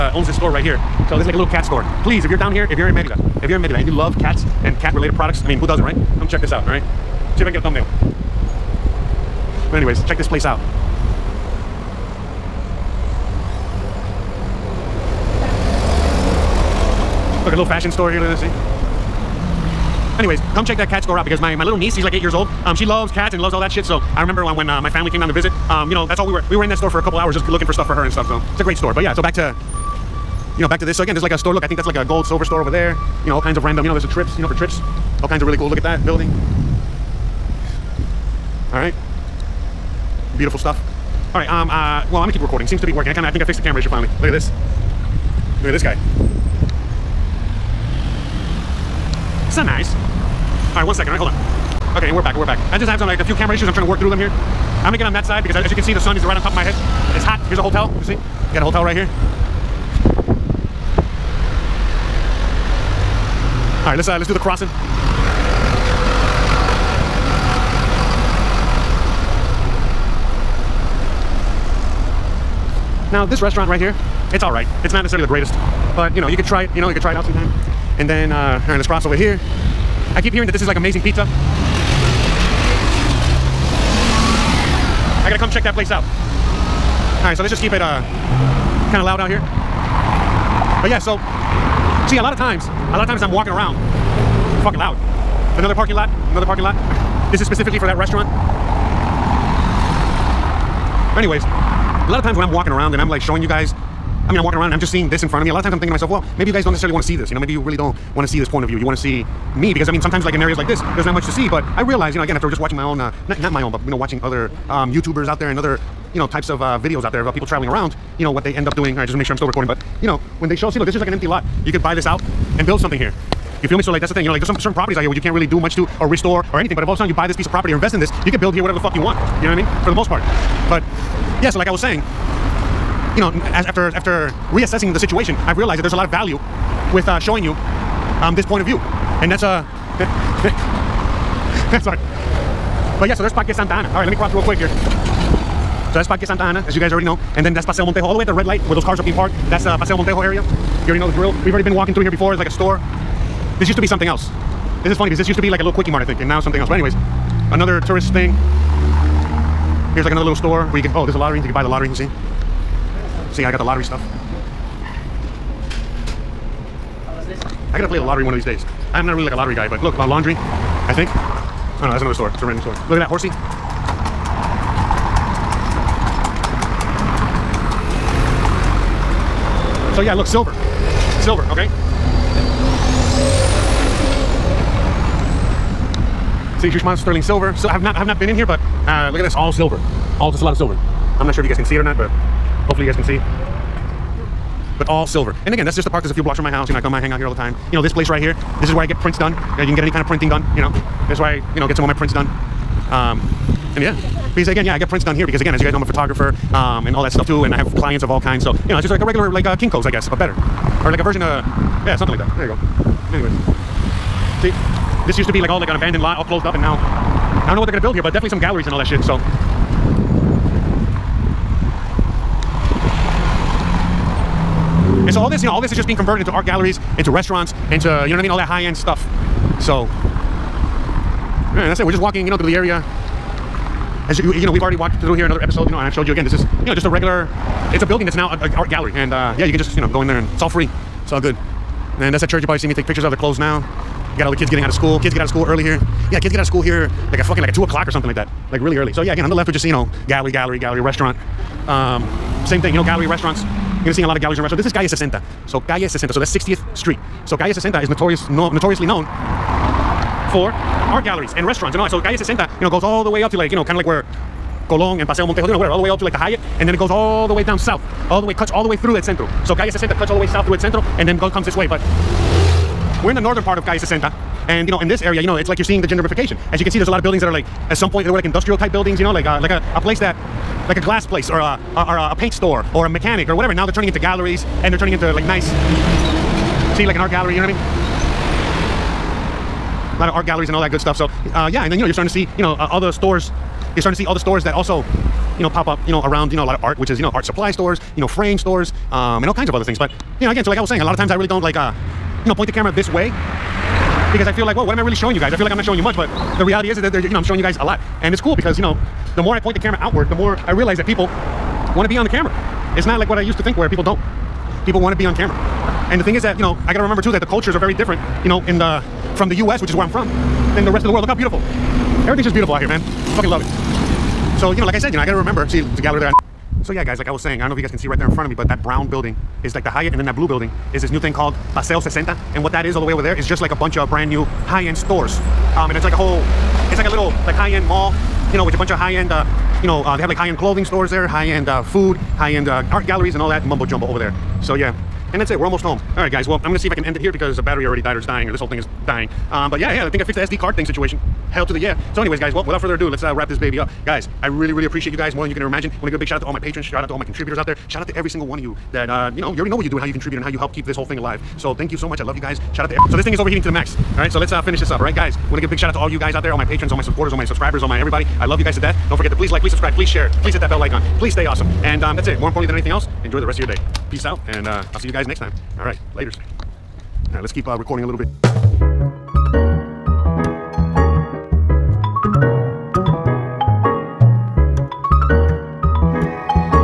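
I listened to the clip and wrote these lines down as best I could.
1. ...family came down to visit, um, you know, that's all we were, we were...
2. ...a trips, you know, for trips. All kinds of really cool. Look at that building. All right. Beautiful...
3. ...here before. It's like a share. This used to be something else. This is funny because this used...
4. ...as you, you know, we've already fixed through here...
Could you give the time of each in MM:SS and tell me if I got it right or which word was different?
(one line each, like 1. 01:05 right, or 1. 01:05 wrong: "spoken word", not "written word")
1. 00:24 right
2. 00:34 right
3. 02:32 wrong: "store", not "share"
4. 03:54 wrong: "walked", not "fixed".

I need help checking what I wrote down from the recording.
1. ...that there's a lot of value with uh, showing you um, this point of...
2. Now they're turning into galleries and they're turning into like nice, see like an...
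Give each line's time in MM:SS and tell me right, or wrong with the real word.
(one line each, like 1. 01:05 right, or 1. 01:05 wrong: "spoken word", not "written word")
1. 02:15 right
2. 04:43 right.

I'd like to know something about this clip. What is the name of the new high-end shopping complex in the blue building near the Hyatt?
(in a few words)
Paseo 60.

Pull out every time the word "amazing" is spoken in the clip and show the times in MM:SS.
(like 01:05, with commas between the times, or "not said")
01:20.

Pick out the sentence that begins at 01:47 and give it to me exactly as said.
You know, maybe you really don't want to see this point of view.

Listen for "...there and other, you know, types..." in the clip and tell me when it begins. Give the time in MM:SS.
01:55.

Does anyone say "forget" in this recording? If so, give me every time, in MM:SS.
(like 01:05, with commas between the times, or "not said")
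06:08.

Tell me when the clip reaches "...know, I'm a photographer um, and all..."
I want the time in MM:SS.
03:25.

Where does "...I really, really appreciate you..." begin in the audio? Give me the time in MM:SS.
05:54.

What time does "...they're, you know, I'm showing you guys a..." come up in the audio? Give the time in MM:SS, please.
05:06.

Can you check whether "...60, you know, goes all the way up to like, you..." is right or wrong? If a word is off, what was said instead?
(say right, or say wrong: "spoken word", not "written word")
right.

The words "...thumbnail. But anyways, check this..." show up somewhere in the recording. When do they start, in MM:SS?
00:07.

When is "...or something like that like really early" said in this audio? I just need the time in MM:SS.
04:07.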